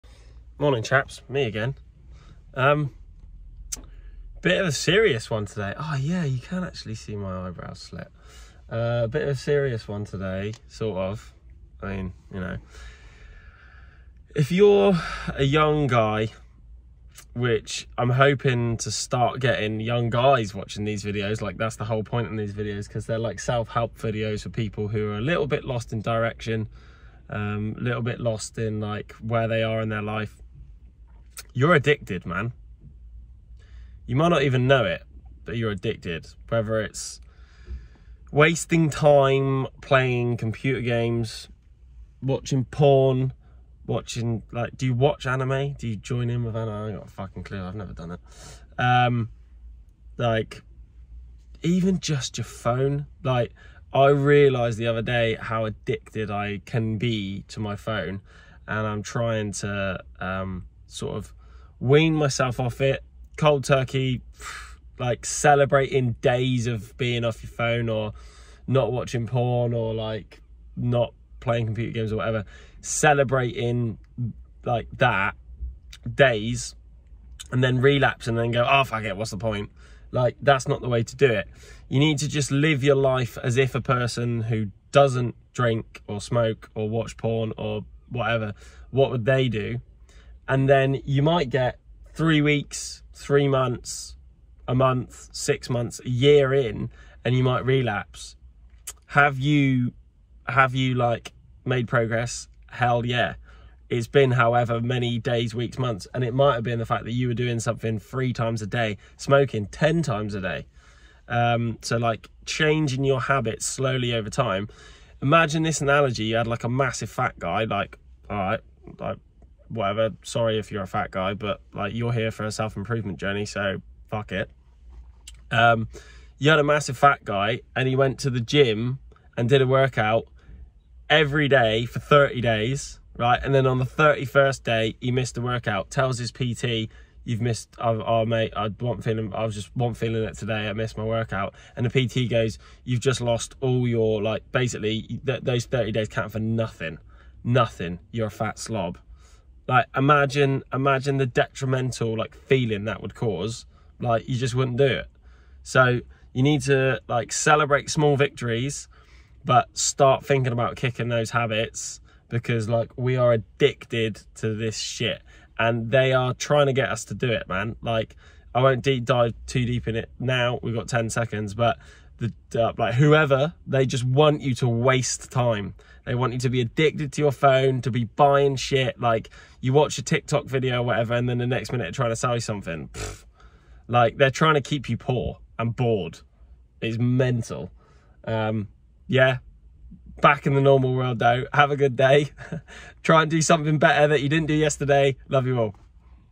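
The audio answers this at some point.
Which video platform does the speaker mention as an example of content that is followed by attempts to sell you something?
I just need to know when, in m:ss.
3:00.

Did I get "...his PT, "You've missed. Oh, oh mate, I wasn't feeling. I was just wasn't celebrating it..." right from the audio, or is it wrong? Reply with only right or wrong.
wrong.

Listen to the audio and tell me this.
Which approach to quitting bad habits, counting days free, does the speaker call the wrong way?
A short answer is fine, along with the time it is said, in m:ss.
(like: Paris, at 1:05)
Cold turkey, at 1:03.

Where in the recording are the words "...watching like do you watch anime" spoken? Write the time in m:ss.
0:43.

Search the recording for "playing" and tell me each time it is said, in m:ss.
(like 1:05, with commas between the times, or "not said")
0:39, 1:11.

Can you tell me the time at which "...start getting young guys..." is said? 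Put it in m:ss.
0:18.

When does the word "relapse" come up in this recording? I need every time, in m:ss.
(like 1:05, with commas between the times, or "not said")
1:17, 1:37.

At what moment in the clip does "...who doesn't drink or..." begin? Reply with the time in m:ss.
1:24.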